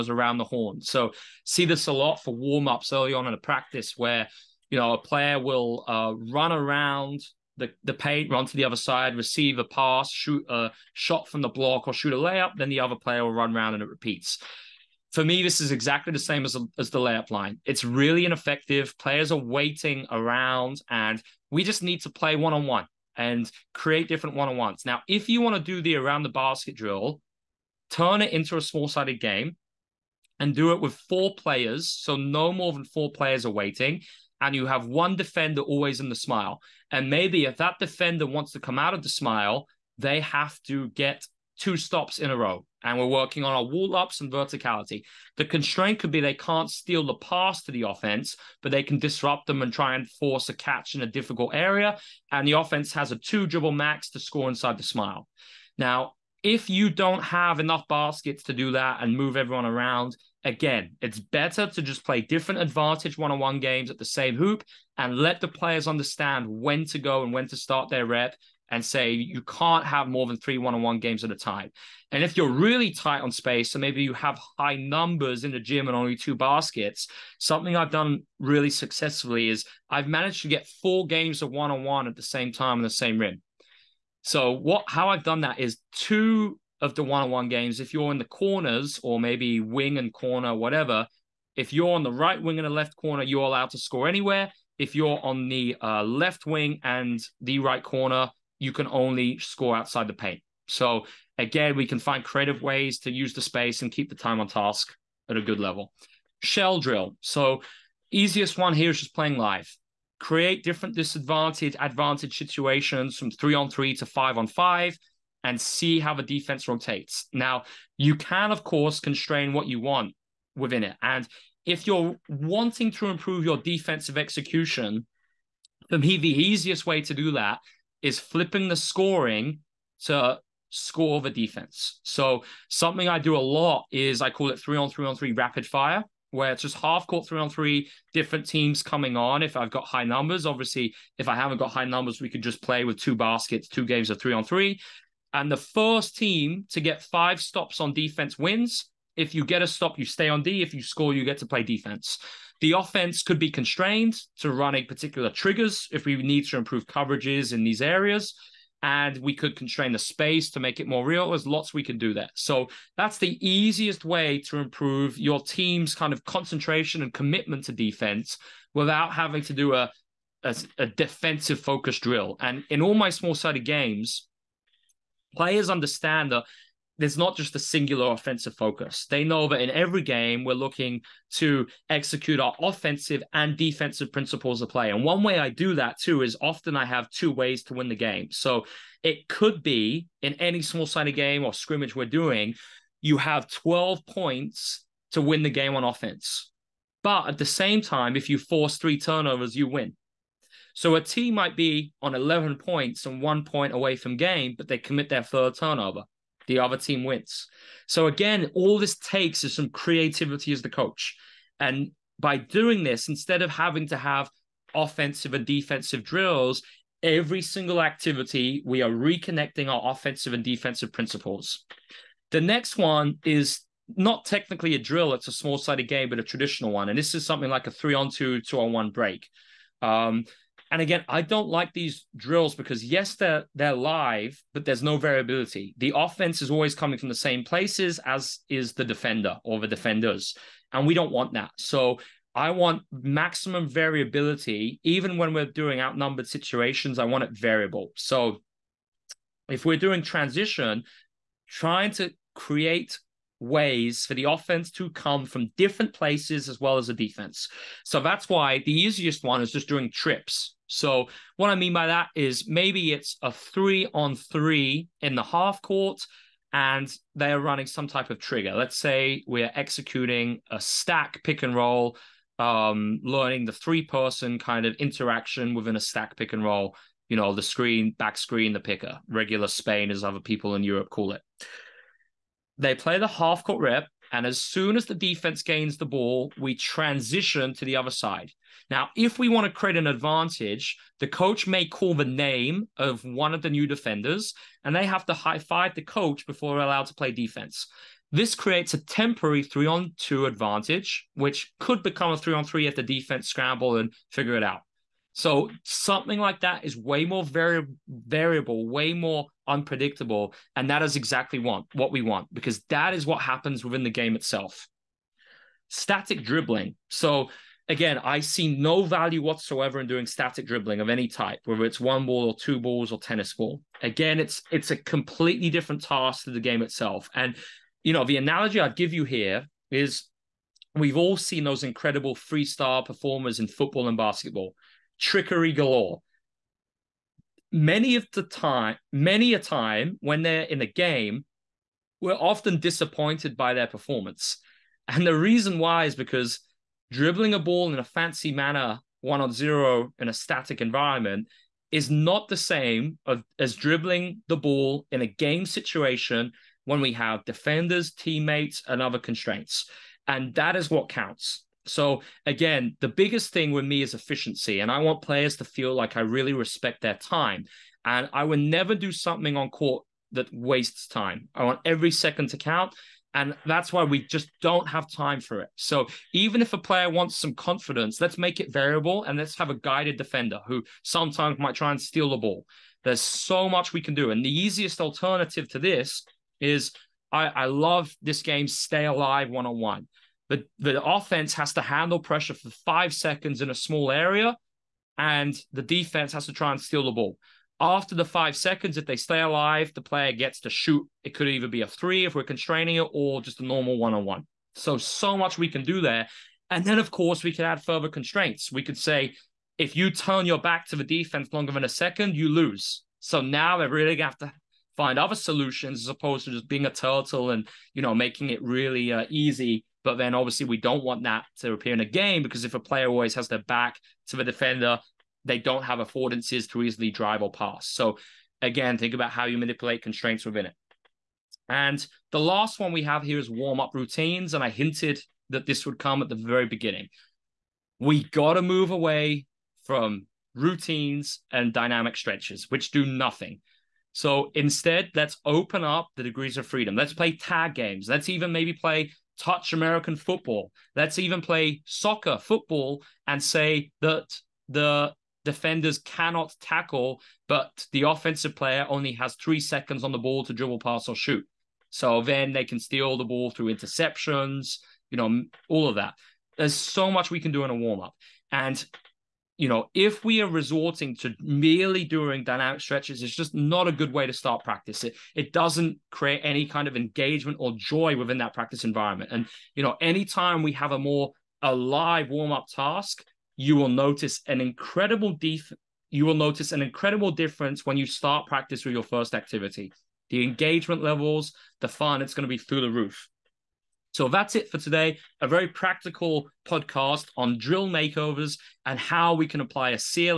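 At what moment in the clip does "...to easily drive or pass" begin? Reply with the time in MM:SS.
07:06.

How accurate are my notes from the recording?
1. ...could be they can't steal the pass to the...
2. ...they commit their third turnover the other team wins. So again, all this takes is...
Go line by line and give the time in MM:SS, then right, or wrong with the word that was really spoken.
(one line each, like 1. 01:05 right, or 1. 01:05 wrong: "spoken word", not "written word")
1. 00:45 right
2. 03:24 right.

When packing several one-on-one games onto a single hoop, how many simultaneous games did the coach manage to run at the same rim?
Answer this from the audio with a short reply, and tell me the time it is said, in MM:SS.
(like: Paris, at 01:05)
4, at 01:20.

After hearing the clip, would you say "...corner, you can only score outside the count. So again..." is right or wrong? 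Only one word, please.
wrong.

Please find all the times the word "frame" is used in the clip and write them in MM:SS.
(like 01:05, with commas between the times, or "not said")
not said.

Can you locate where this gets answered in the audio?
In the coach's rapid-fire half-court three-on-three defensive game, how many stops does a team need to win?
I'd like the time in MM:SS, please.
02:27.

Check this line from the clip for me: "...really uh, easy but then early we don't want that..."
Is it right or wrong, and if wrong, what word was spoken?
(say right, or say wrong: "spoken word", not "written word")
wrong: "obviously", not "early".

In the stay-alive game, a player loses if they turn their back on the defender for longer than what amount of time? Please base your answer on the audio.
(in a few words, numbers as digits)
A second.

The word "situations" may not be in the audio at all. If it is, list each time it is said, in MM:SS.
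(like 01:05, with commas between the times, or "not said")
01:52, 04:06, 05:55.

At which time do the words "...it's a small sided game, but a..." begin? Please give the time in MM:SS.
03:45.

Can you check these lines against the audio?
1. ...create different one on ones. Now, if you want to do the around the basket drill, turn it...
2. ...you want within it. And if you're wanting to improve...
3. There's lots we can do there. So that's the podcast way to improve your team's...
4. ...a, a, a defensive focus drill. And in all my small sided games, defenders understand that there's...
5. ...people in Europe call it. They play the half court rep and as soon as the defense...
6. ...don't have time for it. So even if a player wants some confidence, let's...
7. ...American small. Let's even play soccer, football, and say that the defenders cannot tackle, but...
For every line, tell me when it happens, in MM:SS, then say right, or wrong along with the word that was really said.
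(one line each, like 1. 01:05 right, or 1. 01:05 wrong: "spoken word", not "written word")
1. 00:23 right
2. 01:59 right
3. 02:41 wrong: "easiest", not "podcast"
4. 02:49 wrong: "players", not "defenders"
5. 04:40 right
6. 06:14 right
7. 07:29 wrong: "football", not "small".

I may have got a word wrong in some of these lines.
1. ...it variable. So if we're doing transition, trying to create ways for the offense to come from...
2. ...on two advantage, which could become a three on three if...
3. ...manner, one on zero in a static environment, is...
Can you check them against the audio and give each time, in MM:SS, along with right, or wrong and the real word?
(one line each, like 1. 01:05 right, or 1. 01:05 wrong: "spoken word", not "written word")
1. 04:07 right
2. 04:59 right
3. 05:48 right.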